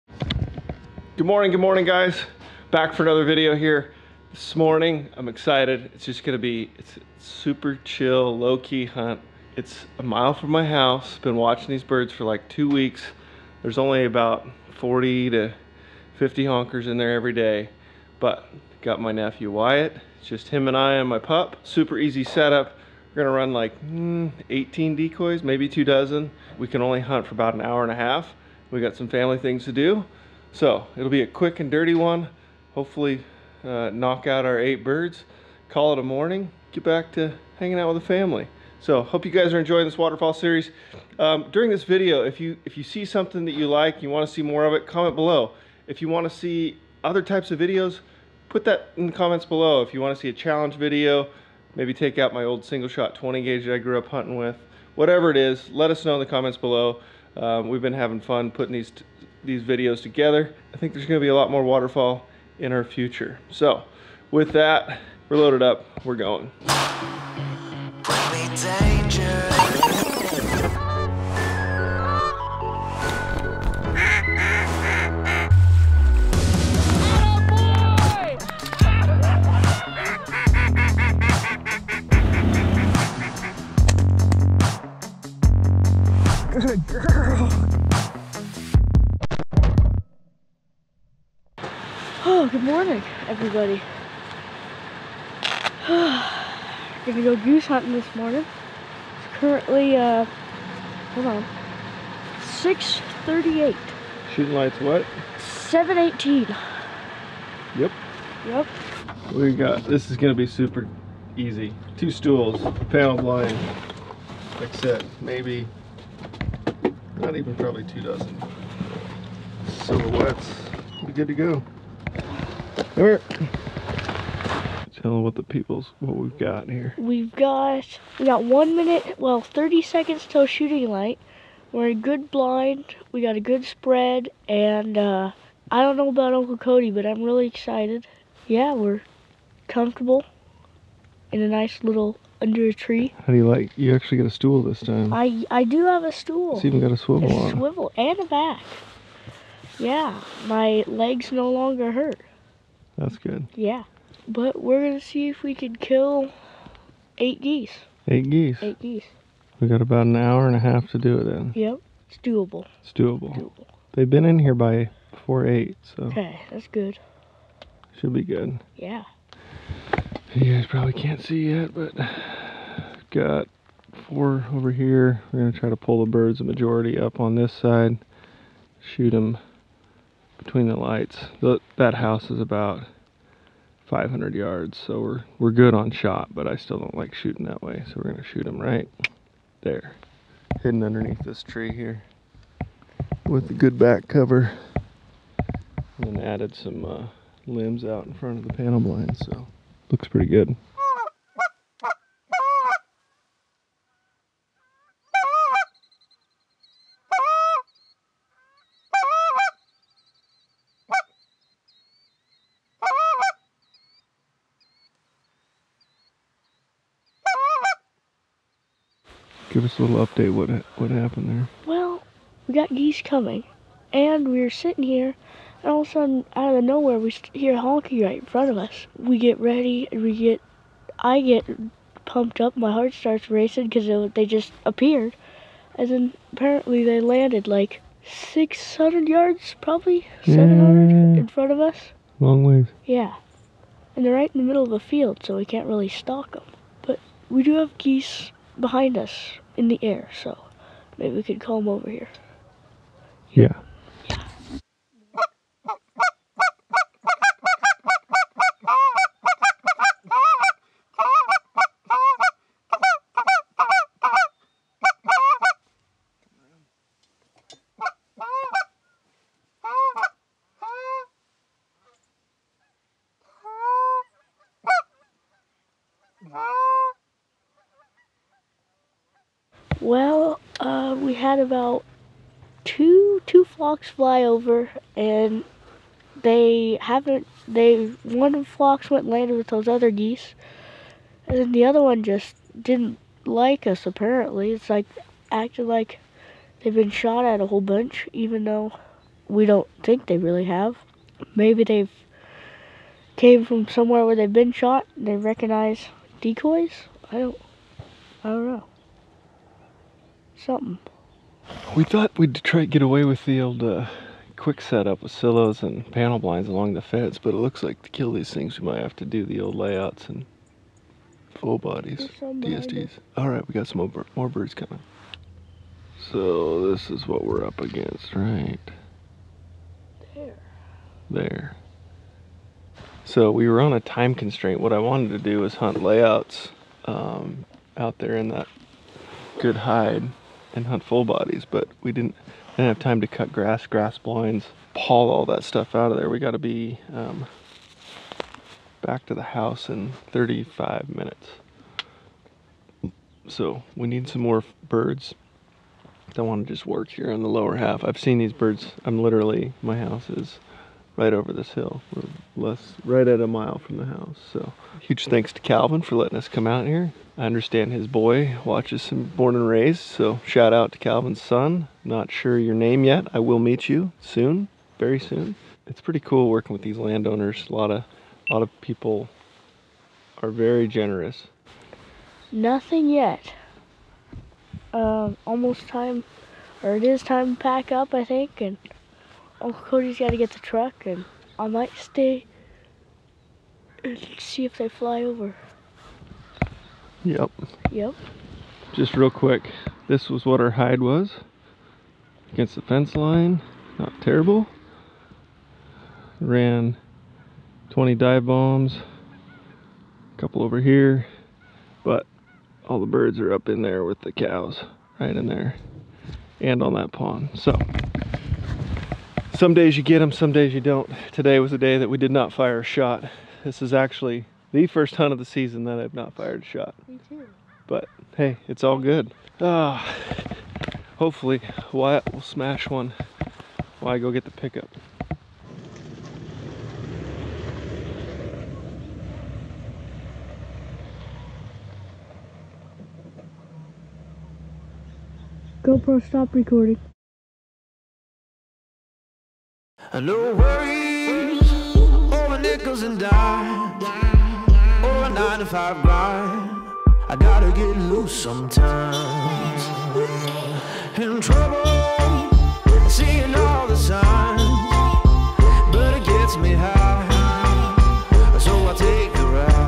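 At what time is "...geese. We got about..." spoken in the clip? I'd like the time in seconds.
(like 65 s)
158 s.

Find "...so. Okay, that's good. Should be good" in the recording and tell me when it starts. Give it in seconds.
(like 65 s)
165 s.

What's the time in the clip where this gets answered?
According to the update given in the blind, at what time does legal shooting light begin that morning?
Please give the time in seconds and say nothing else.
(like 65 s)
105 s.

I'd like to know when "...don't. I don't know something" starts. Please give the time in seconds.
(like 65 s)
307 s.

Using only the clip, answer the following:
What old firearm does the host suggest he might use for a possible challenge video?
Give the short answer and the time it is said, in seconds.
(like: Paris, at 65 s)
single shot 20 gauge, at 52 s.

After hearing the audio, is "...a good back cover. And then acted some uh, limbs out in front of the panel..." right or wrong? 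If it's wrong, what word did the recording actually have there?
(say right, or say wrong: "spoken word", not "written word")
wrong: "added", not "acted".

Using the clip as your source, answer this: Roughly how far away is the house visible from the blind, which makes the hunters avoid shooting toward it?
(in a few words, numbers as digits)
500 yards.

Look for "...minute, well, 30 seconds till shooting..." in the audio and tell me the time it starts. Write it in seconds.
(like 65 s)
128 s.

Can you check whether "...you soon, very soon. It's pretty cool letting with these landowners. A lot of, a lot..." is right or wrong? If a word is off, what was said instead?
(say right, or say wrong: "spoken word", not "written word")
wrong: "working", not "letting".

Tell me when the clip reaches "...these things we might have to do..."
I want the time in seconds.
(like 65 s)
318 s.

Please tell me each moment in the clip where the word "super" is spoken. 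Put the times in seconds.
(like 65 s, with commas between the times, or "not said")
7 s, 21 s, 110 s.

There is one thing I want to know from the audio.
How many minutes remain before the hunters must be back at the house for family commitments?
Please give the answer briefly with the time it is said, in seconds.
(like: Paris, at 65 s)
35 minutes, at 350 s.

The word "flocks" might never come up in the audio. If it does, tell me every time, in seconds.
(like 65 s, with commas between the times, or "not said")
283 s, 288 s.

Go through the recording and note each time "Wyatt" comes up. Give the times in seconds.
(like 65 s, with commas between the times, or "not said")
19 s, 431 s.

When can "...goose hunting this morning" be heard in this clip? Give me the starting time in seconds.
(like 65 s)
97 s.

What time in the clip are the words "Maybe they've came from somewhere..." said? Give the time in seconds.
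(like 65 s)
301 s.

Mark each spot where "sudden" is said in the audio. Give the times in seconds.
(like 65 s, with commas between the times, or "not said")
225 s.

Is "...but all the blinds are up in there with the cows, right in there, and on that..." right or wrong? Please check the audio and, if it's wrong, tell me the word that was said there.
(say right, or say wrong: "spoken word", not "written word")
wrong: "birds", not "blinds".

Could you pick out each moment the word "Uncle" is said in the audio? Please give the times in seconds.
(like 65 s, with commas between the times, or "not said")
136 s, 389 s.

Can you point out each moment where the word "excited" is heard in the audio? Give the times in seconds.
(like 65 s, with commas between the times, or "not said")
5 s, 137 s.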